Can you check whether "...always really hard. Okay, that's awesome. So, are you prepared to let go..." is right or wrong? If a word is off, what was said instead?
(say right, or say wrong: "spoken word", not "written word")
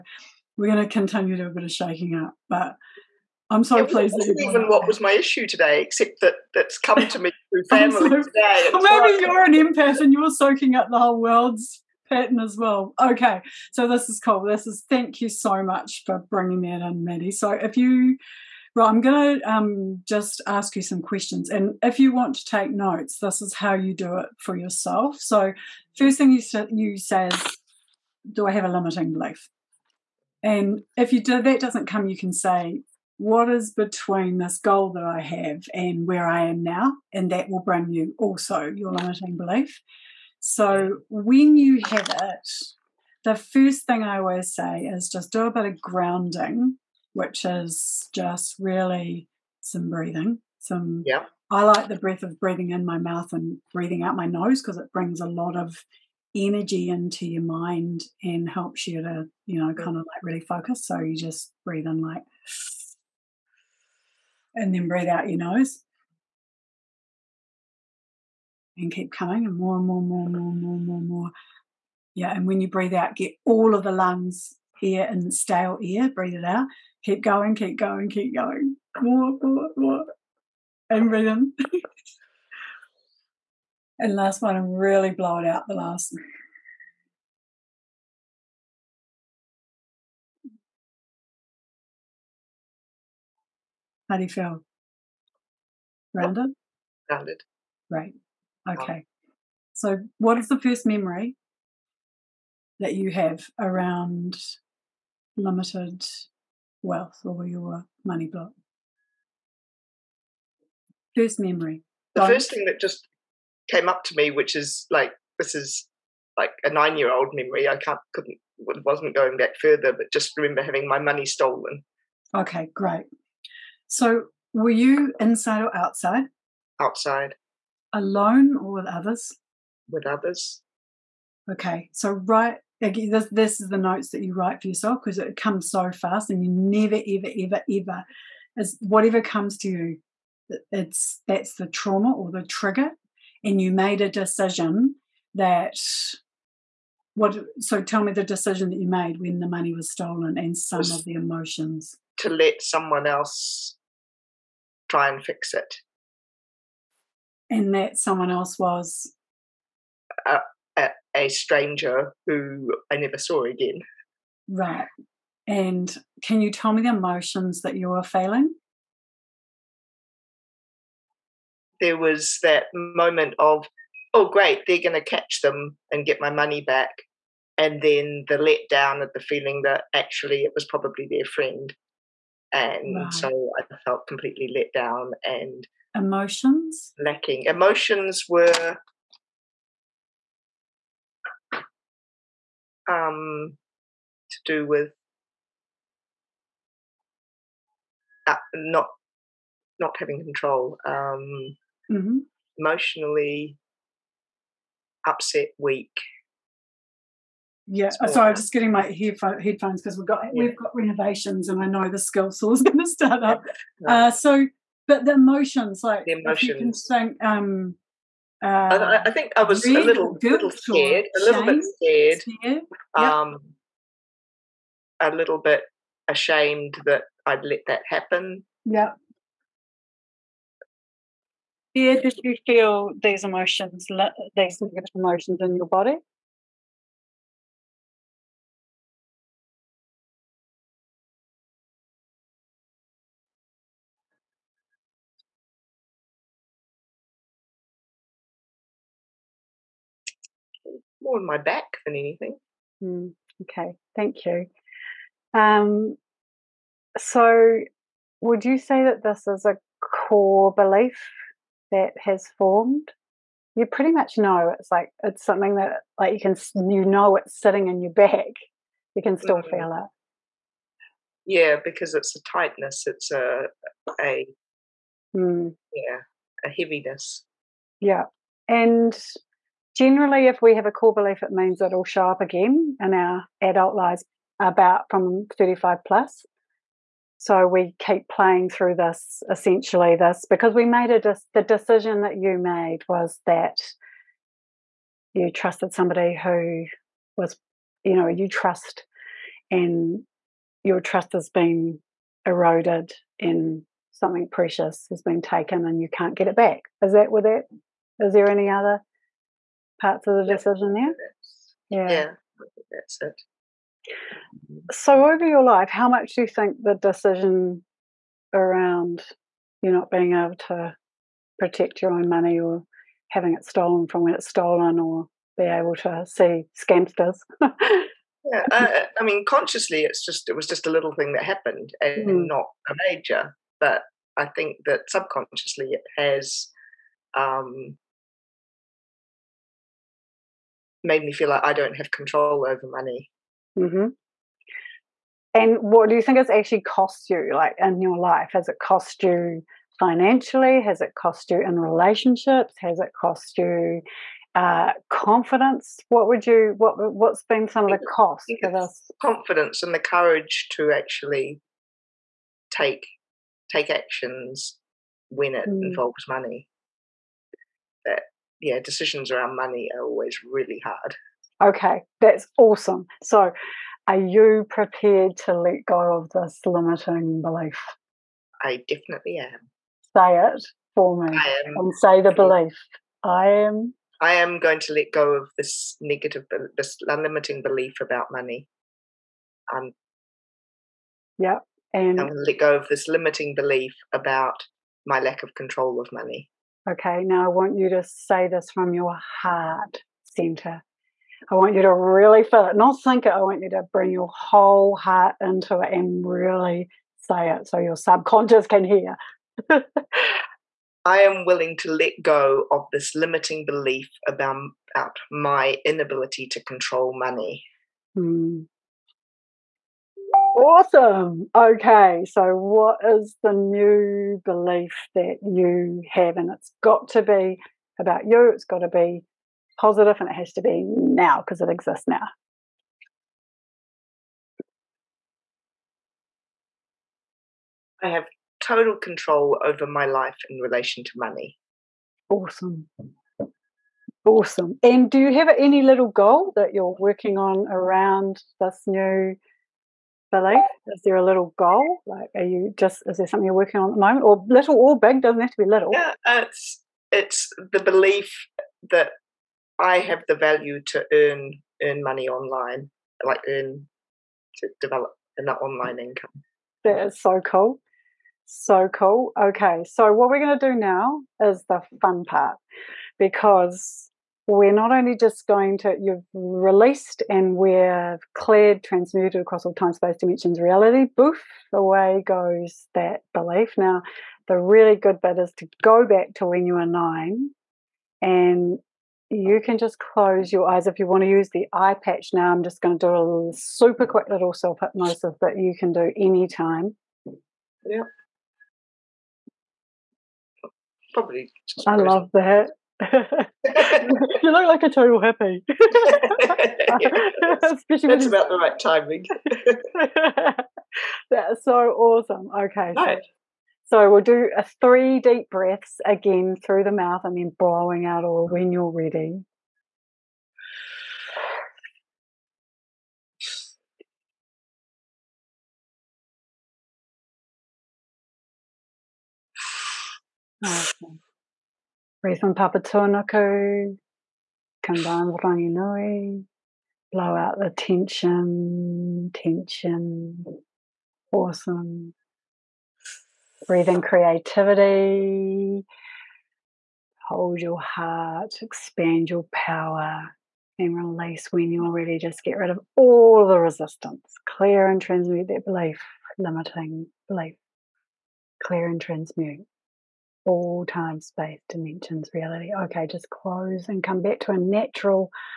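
right.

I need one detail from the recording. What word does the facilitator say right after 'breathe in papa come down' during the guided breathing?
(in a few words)
Rangi.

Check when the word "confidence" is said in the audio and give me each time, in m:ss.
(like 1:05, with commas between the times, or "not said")
5:54, 5:59.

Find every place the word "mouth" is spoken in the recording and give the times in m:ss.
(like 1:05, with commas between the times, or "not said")
0:52, 8:36.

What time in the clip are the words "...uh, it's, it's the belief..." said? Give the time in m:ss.
7:36.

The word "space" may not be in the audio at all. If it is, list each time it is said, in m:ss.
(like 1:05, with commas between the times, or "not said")
7:59, 9:21.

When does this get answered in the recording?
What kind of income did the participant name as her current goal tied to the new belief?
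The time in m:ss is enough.
7:45.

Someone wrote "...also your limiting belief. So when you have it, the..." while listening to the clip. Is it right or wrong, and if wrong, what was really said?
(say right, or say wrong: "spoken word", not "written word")
right.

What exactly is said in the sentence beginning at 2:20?
It's that's the trauma or the trigger, and you made a decision that what.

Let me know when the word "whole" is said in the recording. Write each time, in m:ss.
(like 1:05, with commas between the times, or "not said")
0:10, 6:44.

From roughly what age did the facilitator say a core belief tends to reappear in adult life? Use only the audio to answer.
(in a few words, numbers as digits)
35 plus.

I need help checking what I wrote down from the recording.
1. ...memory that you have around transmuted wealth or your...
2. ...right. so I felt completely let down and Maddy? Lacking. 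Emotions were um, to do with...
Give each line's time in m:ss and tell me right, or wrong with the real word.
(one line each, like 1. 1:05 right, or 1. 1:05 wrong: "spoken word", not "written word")
1. 1:40 wrong: "limited", not "transmuted"
2. 3:02 wrong: "Emotions", not "Maddy".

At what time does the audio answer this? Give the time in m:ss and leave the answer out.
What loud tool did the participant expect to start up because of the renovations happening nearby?
3:31.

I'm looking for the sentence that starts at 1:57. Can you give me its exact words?
I can't couldn't wasn't going back further, but just remember having my money stolen.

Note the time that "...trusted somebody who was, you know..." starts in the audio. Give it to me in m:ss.
4:55.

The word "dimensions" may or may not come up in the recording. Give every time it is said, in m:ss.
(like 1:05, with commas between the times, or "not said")
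7:59, 9:21.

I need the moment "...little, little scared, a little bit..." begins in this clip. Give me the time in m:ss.
3:39.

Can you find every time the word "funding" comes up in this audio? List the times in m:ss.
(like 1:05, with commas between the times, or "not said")
not said.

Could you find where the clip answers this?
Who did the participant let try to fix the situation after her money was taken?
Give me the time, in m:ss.
2:41.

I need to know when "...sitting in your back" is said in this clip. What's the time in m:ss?
4:27.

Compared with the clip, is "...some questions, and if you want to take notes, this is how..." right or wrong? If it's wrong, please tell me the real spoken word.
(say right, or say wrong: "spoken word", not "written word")
right.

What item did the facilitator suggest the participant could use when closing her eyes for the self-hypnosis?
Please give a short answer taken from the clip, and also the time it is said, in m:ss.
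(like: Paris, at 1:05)
Eye patch, at 8:11.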